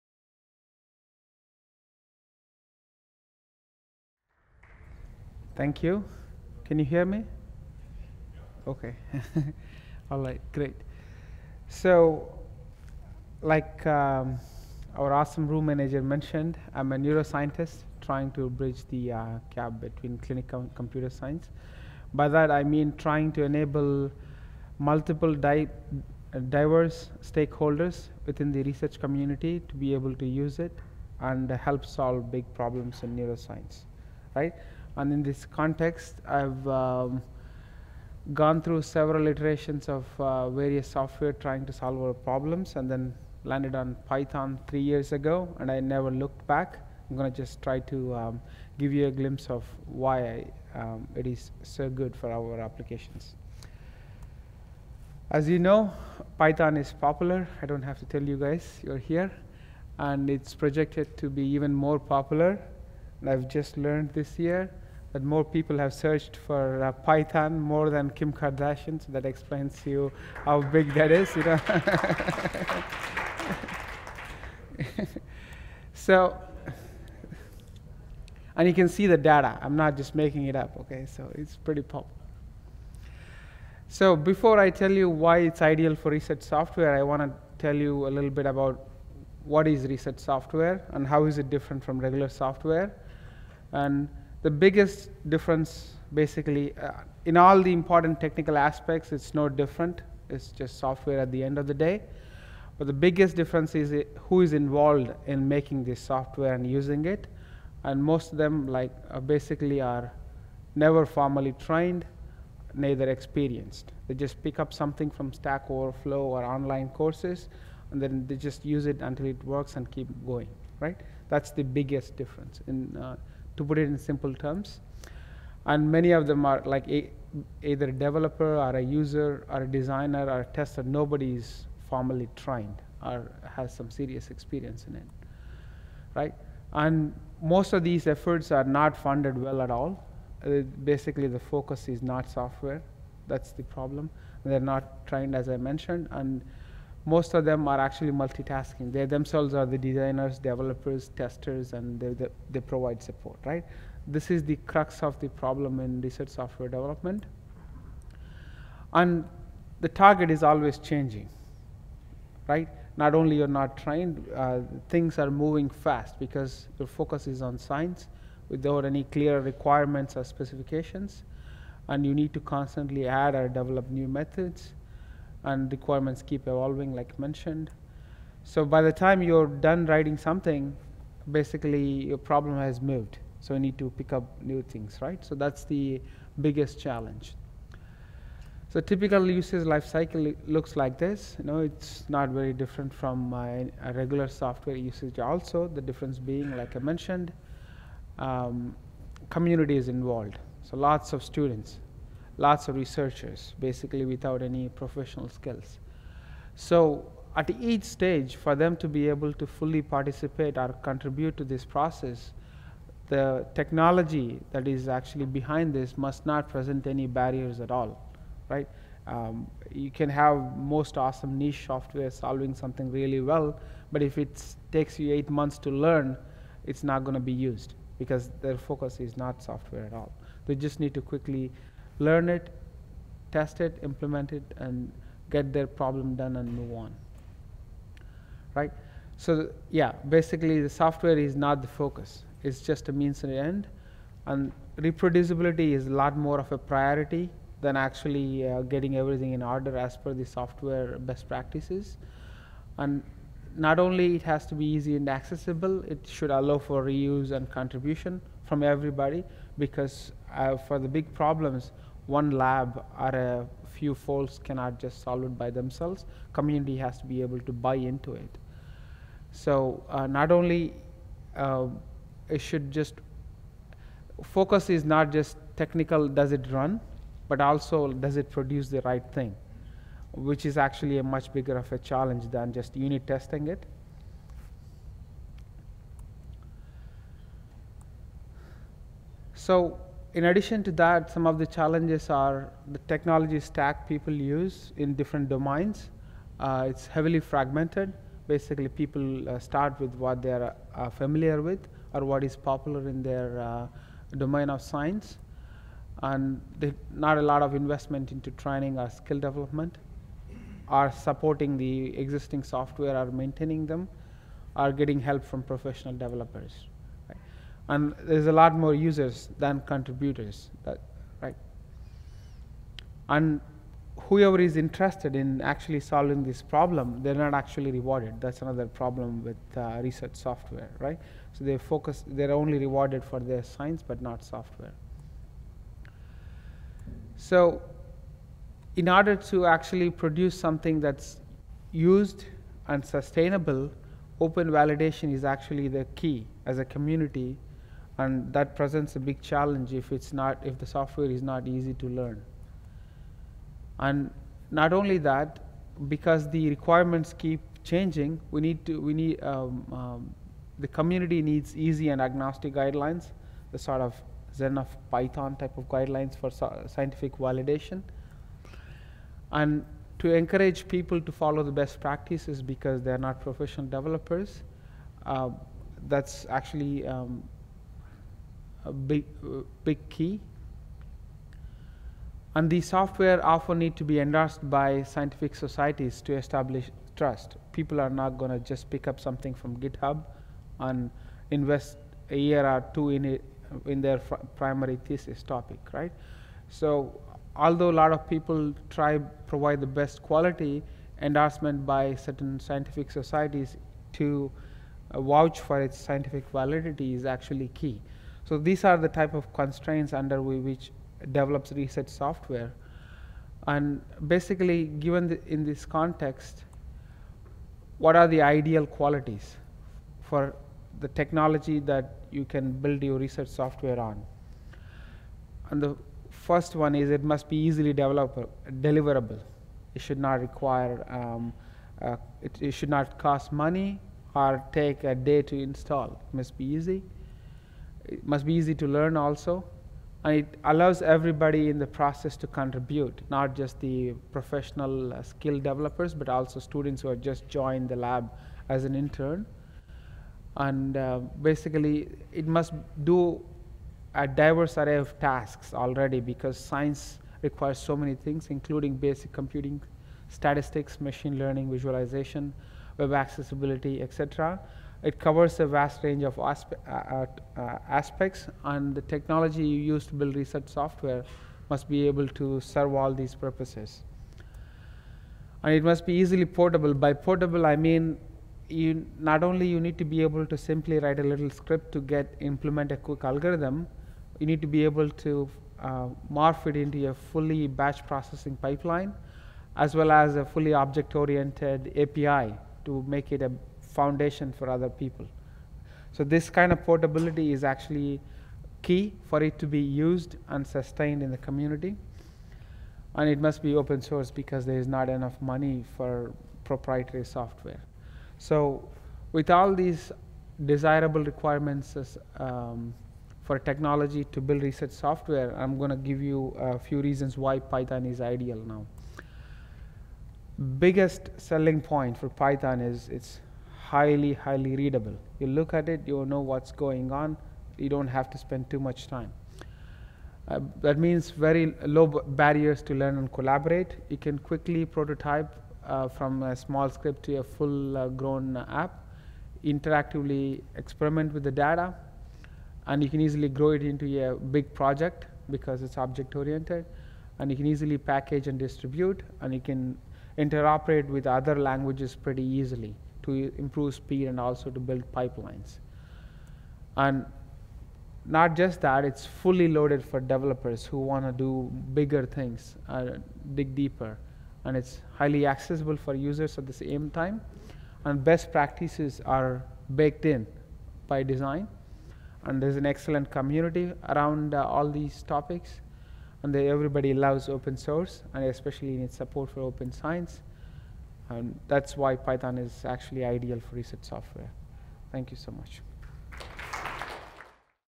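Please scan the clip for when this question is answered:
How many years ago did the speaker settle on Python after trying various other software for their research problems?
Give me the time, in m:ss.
0:44.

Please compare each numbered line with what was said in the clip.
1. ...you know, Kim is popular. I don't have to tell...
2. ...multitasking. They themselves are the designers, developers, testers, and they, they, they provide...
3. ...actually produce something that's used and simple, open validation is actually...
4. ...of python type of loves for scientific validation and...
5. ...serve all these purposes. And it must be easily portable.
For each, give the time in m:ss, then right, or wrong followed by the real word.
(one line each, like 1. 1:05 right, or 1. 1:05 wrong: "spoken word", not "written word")
1. 0:55 wrong: "Python", not "Kim"
2. 2:28 right
3. 5:39 wrong: "sustainable", not "simple"
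4. 6:04 wrong: "guidelines", not "loves"
5. 7:52 right.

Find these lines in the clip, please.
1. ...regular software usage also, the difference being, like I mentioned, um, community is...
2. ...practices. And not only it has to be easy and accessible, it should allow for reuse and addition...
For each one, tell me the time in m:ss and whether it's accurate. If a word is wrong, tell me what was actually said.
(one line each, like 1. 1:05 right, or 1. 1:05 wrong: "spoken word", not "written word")
1. 3:13 right
2. 4:11 wrong: "contribution", not "addition".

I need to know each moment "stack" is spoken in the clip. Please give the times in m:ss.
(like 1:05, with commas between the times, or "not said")
1:55, 4:53.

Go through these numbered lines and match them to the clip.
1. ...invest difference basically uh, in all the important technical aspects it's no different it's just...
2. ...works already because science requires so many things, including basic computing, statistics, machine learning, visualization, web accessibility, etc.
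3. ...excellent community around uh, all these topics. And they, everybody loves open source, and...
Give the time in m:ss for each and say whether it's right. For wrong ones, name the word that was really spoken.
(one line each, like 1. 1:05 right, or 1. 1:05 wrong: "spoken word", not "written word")
1. 1:34 wrong: "biggest", not "invest"
2. 7:34 wrong: "tasks", not "works"
3. 9:32 right.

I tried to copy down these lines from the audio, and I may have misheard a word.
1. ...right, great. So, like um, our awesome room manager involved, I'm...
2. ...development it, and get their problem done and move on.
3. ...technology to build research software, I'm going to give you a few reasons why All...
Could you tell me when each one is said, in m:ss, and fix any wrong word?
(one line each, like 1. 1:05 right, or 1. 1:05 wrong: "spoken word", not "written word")
1. 0:10 wrong: "mentioned", not "involved"
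2. 3:53 wrong: "implement", not "development"
3. 8:33 wrong: "Python", not "All".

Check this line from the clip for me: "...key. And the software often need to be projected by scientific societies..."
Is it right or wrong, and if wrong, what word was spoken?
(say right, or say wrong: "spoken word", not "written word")
wrong: "endorsed", not "projected".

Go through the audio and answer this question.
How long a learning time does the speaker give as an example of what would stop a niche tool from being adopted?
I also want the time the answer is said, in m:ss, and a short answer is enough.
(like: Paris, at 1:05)
8 months, at 3:45.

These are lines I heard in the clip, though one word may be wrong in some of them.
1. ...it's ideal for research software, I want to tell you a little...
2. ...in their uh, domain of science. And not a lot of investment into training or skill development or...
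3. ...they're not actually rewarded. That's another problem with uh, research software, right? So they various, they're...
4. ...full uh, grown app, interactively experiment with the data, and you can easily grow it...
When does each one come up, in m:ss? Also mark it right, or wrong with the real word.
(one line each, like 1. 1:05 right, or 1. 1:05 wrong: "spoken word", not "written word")
1. 1:25 right
2. 5:02 right
3. 5:27 wrong: "focus", not "various"
4. 8:57 right.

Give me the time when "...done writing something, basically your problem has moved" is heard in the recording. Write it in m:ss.
2:59.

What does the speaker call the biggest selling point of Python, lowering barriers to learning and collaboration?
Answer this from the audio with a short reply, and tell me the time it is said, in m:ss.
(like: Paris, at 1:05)
Highly readable, at 8:43.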